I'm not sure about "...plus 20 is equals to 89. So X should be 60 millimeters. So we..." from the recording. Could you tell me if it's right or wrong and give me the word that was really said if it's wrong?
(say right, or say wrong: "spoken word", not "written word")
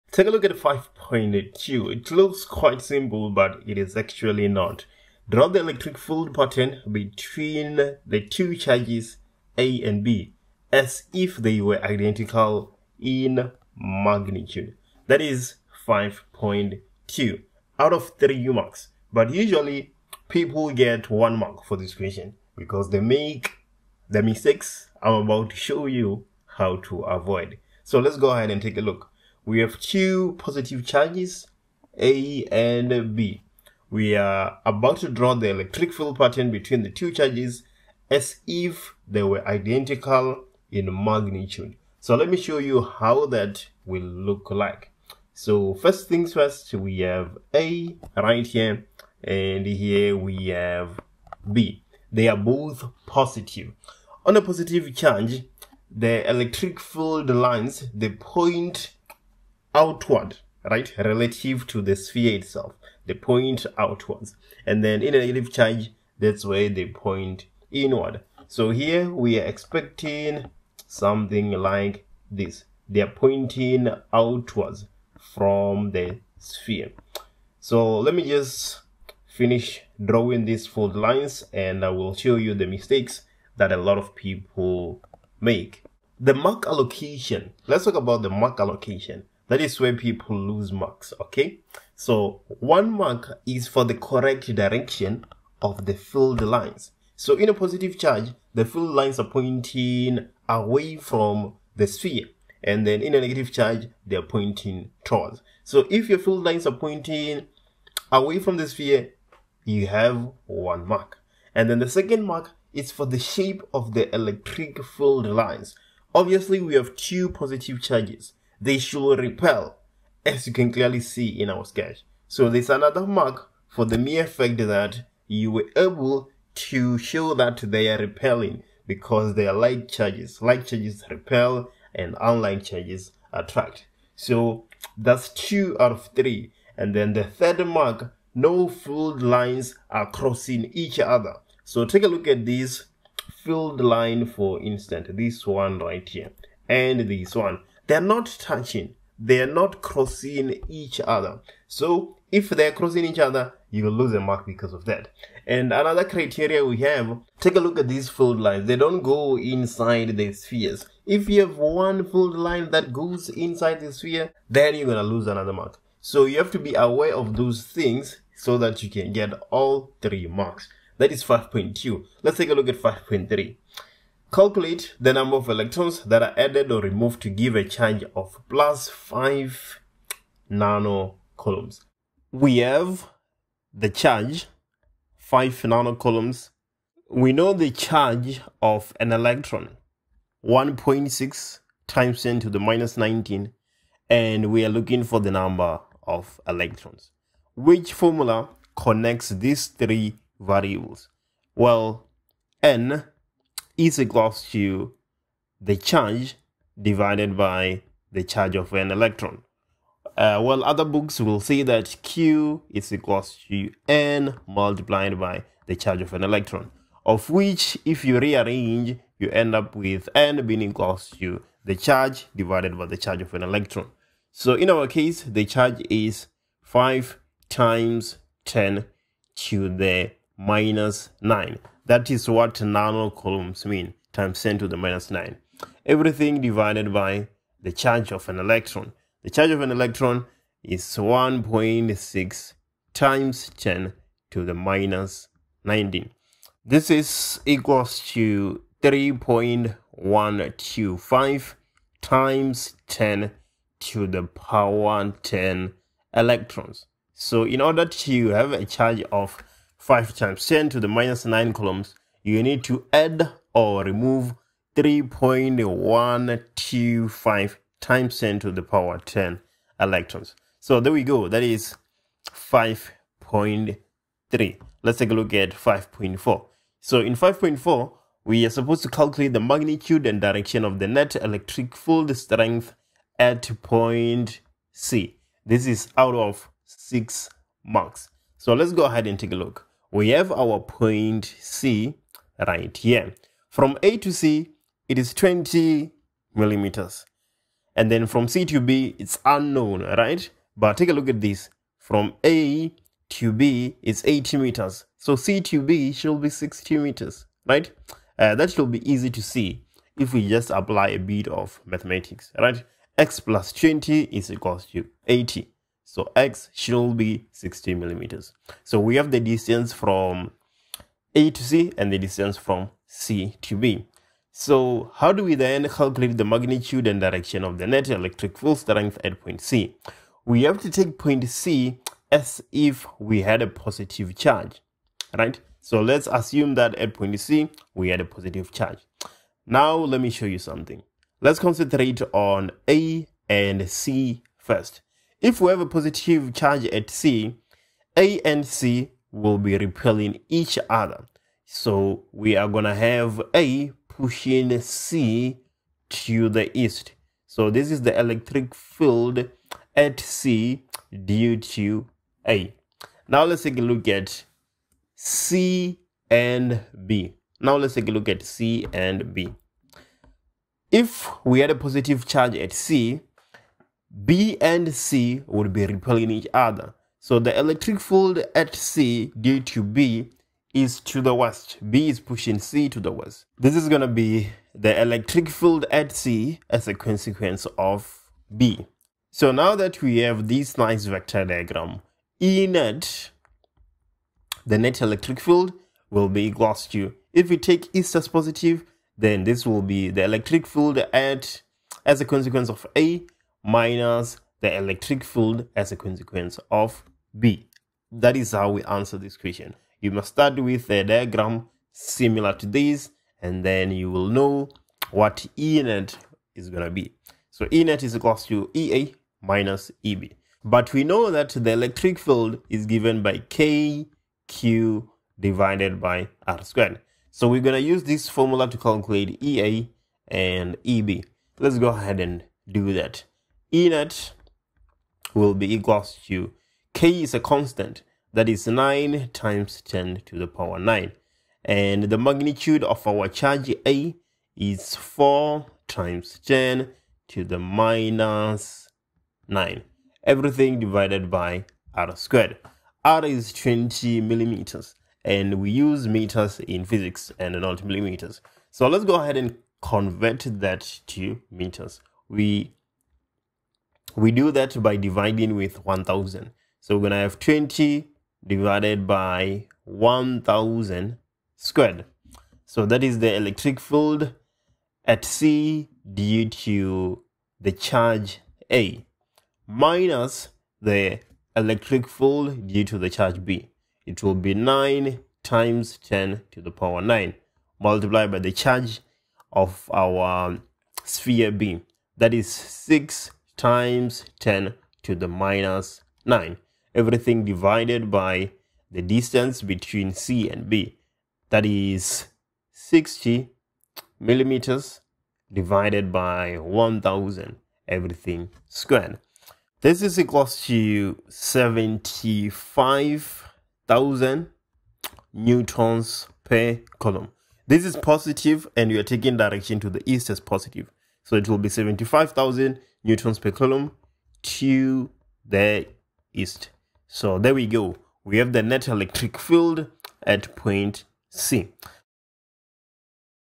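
wrong: "80", not "89".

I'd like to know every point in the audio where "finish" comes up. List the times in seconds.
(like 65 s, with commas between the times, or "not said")
79 s.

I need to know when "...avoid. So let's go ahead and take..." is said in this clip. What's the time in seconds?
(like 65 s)
27 s.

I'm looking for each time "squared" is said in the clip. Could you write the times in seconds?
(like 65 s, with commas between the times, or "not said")
426 s, 451 s, 471 s, 508 s.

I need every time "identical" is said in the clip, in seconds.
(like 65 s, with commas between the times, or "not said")
11 s, 39 s.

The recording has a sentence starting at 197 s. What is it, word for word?
Which formula connects these three variables?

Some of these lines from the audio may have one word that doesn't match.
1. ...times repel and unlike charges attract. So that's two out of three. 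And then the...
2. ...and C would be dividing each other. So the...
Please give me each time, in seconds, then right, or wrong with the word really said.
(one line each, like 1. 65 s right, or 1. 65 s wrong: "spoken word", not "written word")
1. 130 s wrong: "charges", not "times"
2. 374 s wrong: "repelling", not "dividing".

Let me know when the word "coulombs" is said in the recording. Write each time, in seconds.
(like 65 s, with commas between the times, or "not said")
180 s, 185 s, 261 s, 516 s, 523 s.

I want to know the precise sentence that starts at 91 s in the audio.
So one mark is for the correct direction of the field lines.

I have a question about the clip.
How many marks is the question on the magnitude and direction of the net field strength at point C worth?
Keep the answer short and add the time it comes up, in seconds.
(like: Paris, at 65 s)
6, at 286 s.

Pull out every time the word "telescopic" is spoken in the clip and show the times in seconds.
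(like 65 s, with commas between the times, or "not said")
not said.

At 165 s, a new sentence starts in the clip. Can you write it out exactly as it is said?
So you have to be aware of those things so that you can get all three marks.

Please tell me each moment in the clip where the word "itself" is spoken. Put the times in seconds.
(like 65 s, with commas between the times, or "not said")
62 s.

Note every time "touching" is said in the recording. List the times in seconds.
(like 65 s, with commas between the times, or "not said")
148 s.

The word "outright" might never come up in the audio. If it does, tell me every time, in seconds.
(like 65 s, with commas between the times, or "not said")
not said.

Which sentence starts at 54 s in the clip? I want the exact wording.
On a positive charge, the electric field lines, the point outward, right?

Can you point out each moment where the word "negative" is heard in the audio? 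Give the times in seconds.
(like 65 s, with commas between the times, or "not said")
65 s, 103 s.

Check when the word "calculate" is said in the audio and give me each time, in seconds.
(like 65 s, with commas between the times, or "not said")
174 s, 278 s, 325 s, 428 s.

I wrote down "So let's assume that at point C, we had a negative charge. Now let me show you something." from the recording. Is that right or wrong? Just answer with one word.
wrong.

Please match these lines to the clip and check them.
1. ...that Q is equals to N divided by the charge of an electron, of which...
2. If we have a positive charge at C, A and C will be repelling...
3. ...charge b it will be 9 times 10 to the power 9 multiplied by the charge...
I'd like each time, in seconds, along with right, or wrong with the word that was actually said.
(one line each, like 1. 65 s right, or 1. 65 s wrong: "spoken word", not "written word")
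1. 211 s wrong: "multiplied", not "divided"
2. 345 s right
3. 482 s right.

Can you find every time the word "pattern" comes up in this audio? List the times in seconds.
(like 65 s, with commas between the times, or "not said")
6 s, 36 s.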